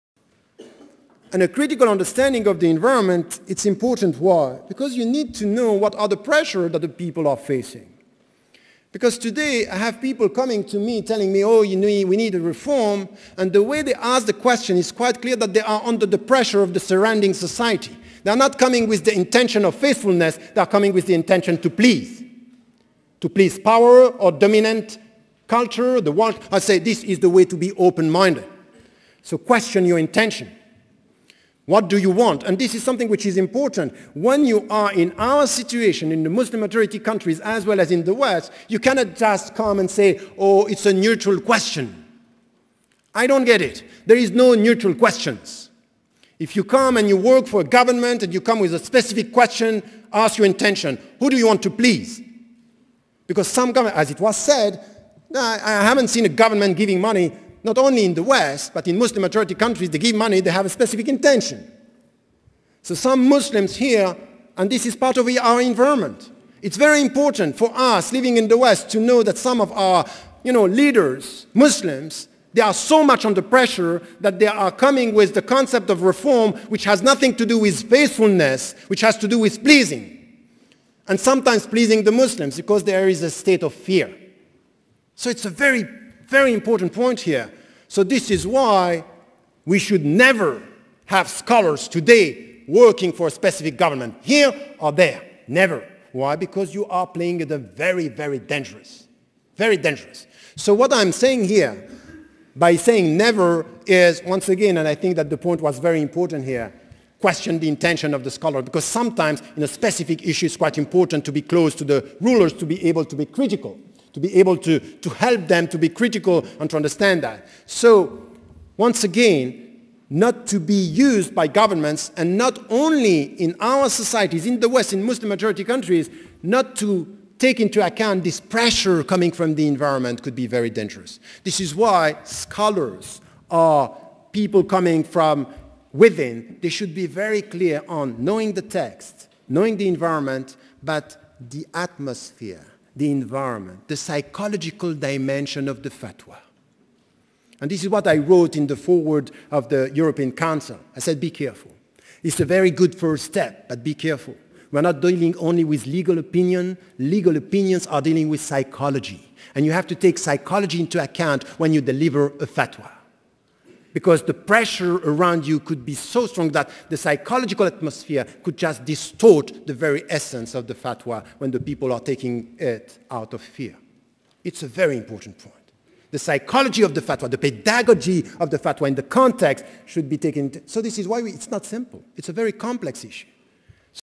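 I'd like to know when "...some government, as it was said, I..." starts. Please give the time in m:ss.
0:53.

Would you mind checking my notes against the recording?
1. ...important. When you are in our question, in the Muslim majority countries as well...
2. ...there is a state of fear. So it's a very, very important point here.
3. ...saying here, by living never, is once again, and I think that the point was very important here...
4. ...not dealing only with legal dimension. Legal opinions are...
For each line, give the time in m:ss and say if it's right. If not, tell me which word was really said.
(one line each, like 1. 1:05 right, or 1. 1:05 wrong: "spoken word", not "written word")
1. 0:33 wrong: "situation", not "question"
2. 1:22 right
3. 1:41 wrong: "saying", not "living"
4. 2:34 wrong: "opinion", not "dimension".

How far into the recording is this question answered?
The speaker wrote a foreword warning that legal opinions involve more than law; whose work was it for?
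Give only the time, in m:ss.
2:29.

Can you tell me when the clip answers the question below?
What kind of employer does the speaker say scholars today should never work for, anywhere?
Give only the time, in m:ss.
1:33.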